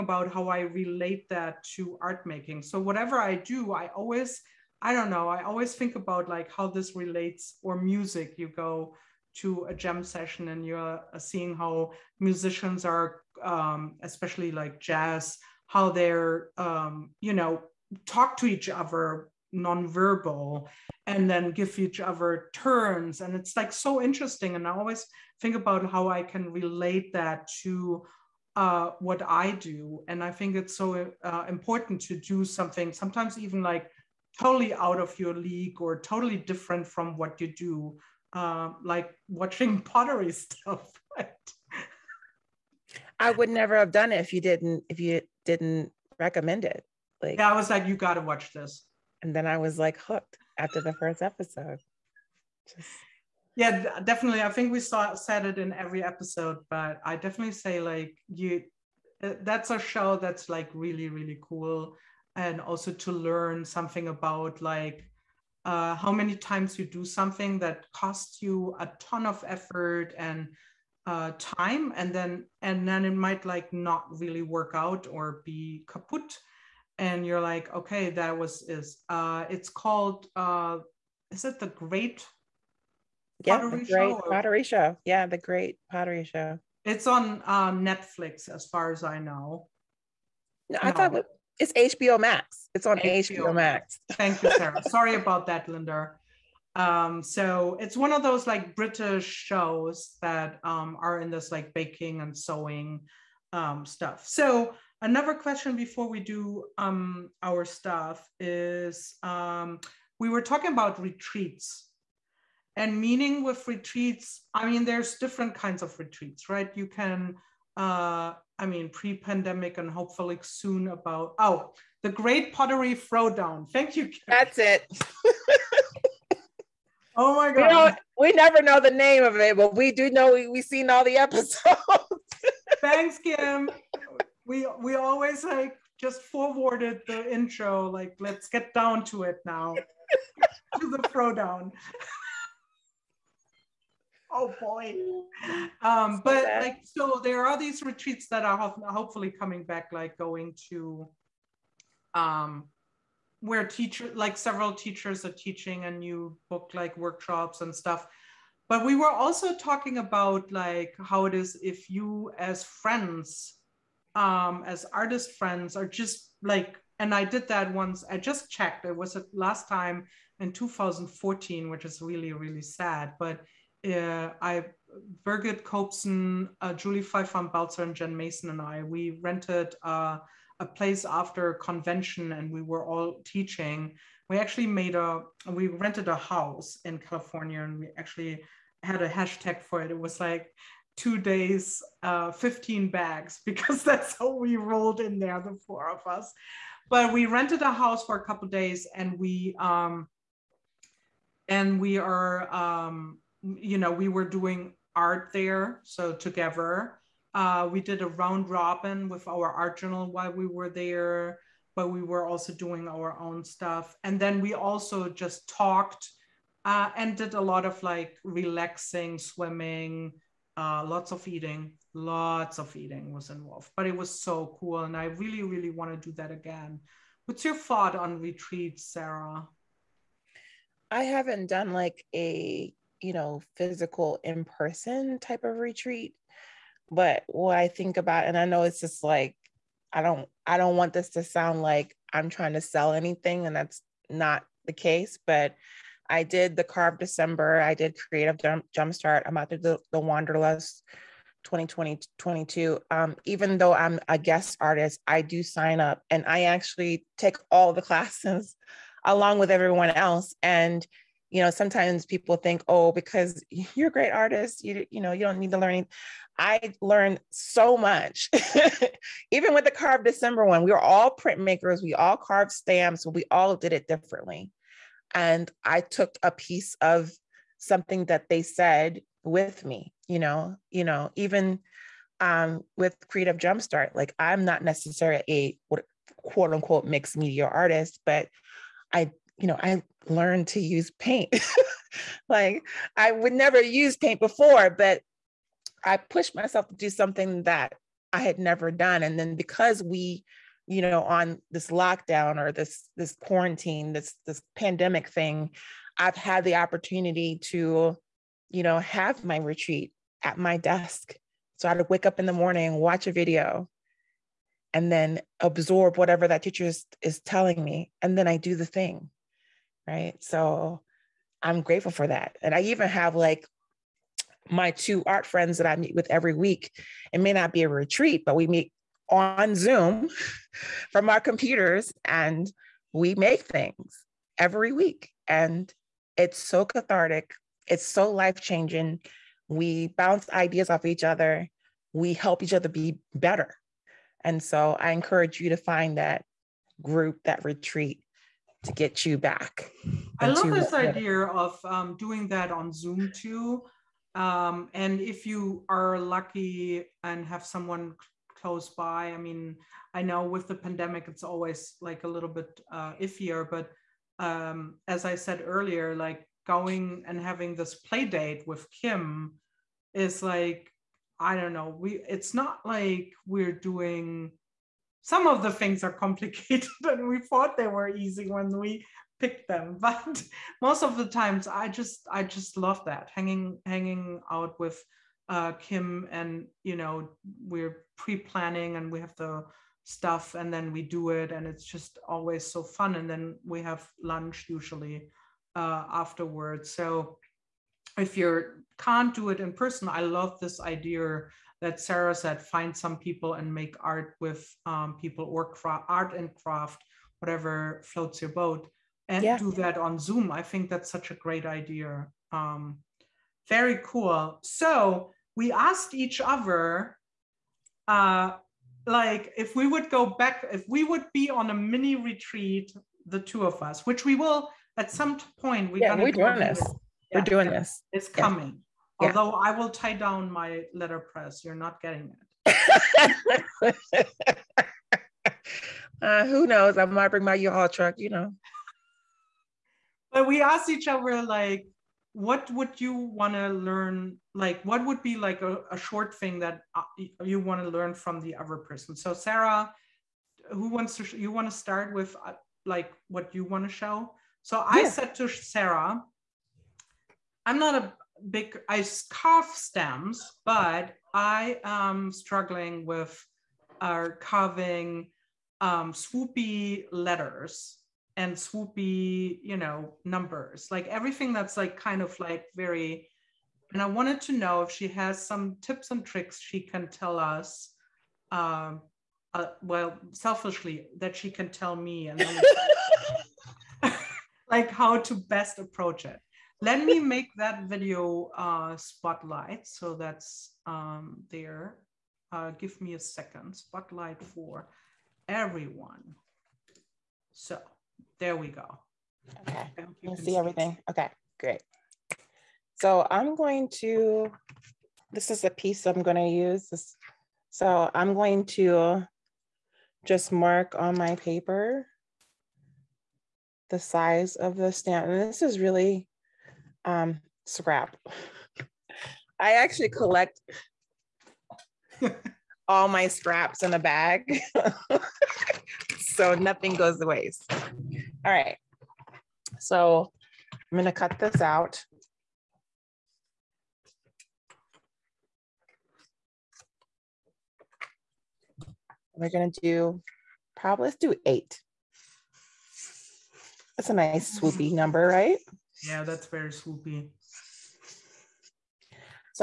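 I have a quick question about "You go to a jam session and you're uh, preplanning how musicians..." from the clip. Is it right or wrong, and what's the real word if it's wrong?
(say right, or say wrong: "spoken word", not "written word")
wrong: "seeing", not "preplanning".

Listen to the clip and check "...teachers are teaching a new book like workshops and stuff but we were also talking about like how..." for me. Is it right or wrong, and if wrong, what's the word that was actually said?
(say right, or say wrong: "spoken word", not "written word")
right.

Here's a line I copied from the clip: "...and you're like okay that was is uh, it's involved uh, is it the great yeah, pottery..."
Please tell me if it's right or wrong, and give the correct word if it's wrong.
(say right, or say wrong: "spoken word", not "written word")
wrong: "called", not "involved".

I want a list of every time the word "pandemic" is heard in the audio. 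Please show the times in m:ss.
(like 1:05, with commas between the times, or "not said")
1:58, 5:04, 6:00.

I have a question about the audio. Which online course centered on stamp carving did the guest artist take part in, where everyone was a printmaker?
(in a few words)
Carve December.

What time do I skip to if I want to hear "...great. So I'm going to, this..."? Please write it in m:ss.
8:21.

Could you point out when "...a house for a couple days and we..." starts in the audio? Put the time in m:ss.
3:17.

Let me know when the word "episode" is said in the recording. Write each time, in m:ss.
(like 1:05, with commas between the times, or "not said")
0:51, 0:56, 2:11.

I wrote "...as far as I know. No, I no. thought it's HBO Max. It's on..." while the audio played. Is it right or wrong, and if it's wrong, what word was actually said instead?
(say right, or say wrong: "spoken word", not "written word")
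right.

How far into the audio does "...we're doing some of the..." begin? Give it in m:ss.
6:13.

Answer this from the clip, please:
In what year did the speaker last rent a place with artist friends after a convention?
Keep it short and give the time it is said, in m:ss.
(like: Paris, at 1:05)
2014, at 2:50.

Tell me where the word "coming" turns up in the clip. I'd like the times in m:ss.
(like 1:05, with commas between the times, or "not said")
2:29, 7:08.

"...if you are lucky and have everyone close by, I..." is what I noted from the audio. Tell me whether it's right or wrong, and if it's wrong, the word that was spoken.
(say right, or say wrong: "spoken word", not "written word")
wrong: "someone", not "everyone".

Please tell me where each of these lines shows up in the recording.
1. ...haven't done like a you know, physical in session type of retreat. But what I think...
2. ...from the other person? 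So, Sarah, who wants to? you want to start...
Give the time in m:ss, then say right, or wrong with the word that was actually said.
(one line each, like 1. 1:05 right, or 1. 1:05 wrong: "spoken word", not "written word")
1. 3:51 wrong: "person", not "session"
2. 7:27 right.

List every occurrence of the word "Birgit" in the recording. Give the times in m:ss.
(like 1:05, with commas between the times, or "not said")
2:55.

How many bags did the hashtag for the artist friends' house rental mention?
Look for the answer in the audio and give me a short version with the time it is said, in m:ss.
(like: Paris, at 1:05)
15, at 3:12.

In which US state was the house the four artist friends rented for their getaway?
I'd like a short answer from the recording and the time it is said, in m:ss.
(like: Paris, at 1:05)
California, at 3:06.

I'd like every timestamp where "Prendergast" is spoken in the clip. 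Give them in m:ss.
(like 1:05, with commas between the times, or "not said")
not said.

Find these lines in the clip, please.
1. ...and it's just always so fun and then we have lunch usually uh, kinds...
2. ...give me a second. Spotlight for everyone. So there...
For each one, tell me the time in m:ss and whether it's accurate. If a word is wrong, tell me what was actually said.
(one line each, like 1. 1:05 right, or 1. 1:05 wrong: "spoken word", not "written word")
1. 6:31 wrong: "afterwards", not "kinds"
2. 8:12 right.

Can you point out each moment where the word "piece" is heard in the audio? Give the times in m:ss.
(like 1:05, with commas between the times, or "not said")
4:36, 8:25.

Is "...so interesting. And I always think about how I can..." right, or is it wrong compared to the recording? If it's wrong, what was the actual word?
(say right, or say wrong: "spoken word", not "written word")
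right.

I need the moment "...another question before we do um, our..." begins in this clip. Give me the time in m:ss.
1:45.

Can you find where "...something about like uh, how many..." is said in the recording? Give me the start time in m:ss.
1:03.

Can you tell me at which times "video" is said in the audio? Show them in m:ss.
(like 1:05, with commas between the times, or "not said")
5:13, 8:07.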